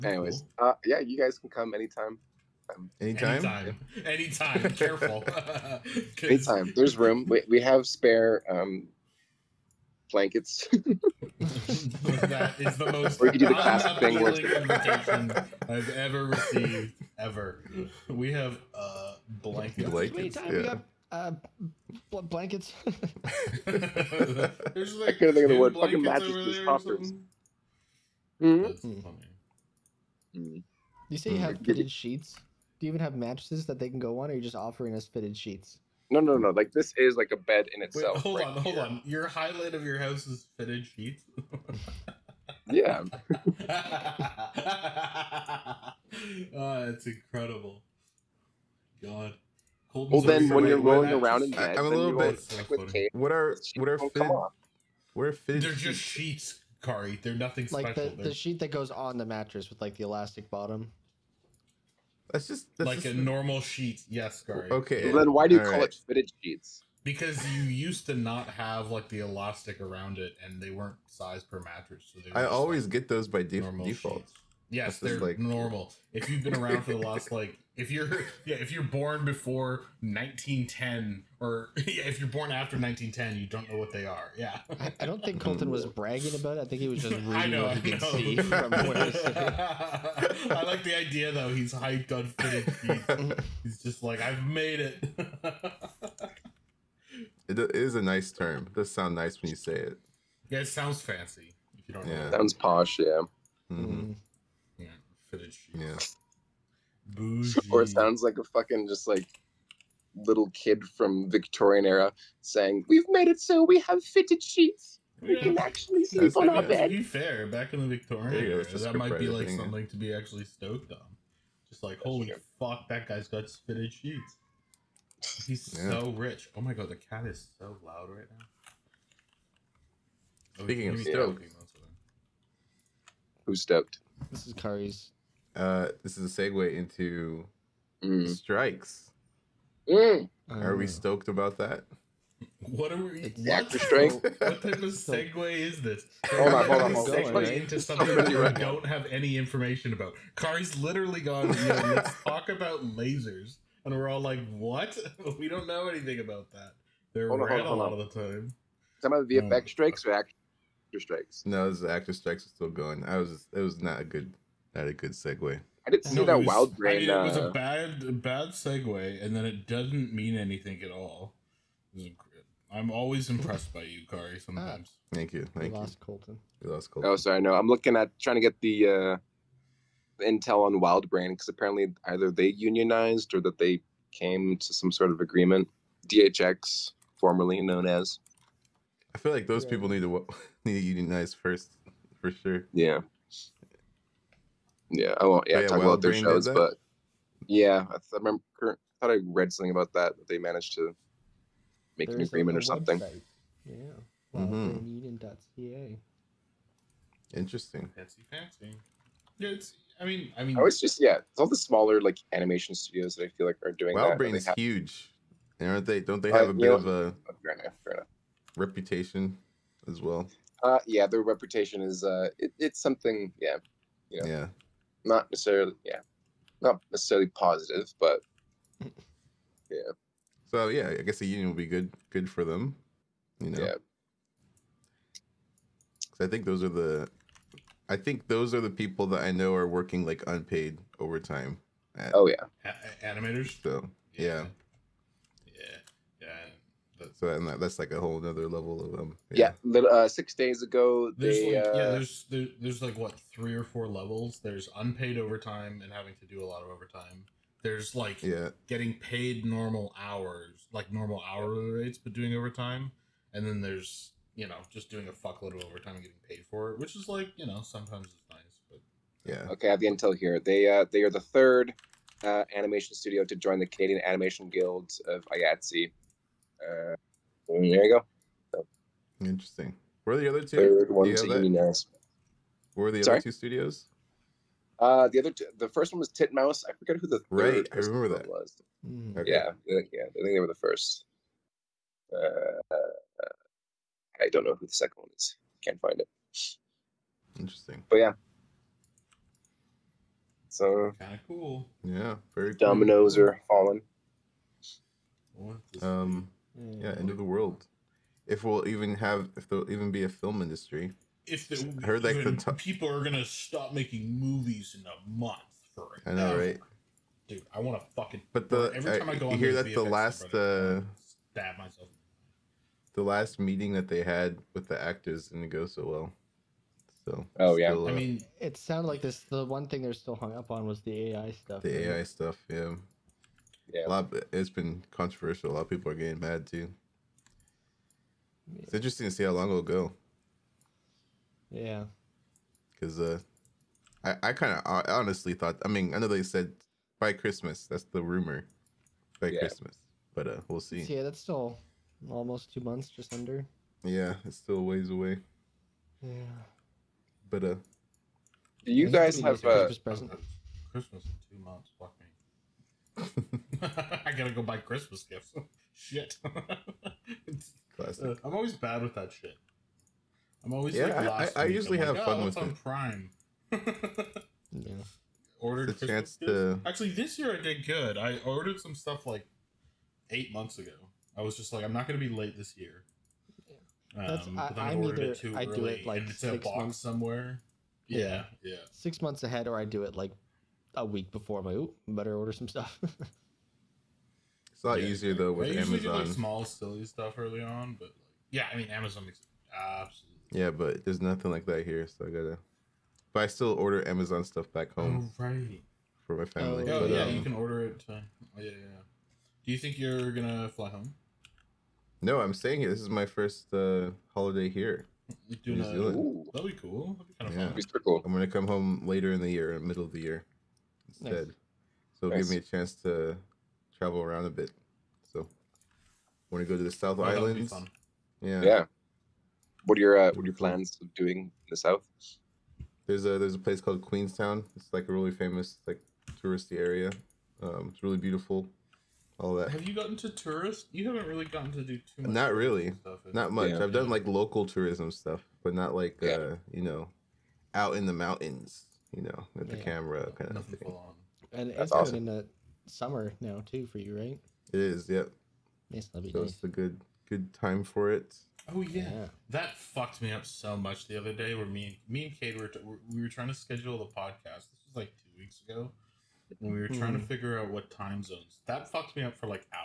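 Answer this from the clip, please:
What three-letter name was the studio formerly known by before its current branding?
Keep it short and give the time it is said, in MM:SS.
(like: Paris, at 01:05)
DHX, at 03:06.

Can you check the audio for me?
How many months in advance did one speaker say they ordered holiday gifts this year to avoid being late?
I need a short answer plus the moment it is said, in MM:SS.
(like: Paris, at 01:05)
8, at 06:20.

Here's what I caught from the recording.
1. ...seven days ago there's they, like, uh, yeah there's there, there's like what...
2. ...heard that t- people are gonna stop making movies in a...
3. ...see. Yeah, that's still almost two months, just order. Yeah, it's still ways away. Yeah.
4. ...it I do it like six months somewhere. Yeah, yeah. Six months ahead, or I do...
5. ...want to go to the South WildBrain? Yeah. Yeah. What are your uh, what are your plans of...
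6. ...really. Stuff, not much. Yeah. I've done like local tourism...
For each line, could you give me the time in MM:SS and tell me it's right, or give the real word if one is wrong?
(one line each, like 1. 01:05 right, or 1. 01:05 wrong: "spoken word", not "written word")
1. 04:10 wrong: "six", not "seven"
2. 05:11 right
3. 05:50 wrong: "under", not "order"
4. 06:25 right
5. 07:06 wrong: "Islands", not "WildBrain"
6. 07:22 right.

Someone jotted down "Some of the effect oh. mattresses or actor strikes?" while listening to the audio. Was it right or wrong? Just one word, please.
wrong.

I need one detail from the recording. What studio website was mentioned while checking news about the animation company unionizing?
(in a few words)
wildbraineden.ca.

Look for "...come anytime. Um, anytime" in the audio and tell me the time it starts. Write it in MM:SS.
00:01.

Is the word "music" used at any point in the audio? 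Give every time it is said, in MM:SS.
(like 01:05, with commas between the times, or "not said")
not said.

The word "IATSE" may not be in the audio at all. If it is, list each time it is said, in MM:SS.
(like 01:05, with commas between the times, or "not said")
04:35.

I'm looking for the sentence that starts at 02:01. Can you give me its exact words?
Just like, holy fuck, that guy's got fitted sheets.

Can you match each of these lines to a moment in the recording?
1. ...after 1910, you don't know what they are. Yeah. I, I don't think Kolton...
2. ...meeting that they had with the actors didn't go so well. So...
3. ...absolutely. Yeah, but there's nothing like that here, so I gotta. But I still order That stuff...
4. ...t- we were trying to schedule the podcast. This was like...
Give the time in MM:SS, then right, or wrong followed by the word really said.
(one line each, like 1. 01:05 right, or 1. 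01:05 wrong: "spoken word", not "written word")
1. 01:22 right
2. 05:23 right
3. 06:39 wrong: "Amazon", not "That"
4. 07:42 right.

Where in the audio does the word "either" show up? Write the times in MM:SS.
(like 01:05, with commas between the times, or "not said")
03:02, 06:24.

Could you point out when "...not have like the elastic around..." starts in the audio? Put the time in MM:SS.
01:08.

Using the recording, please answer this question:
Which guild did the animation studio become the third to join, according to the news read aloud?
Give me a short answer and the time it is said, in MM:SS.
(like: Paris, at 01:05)
Canadian Animation Guild, at 04:33.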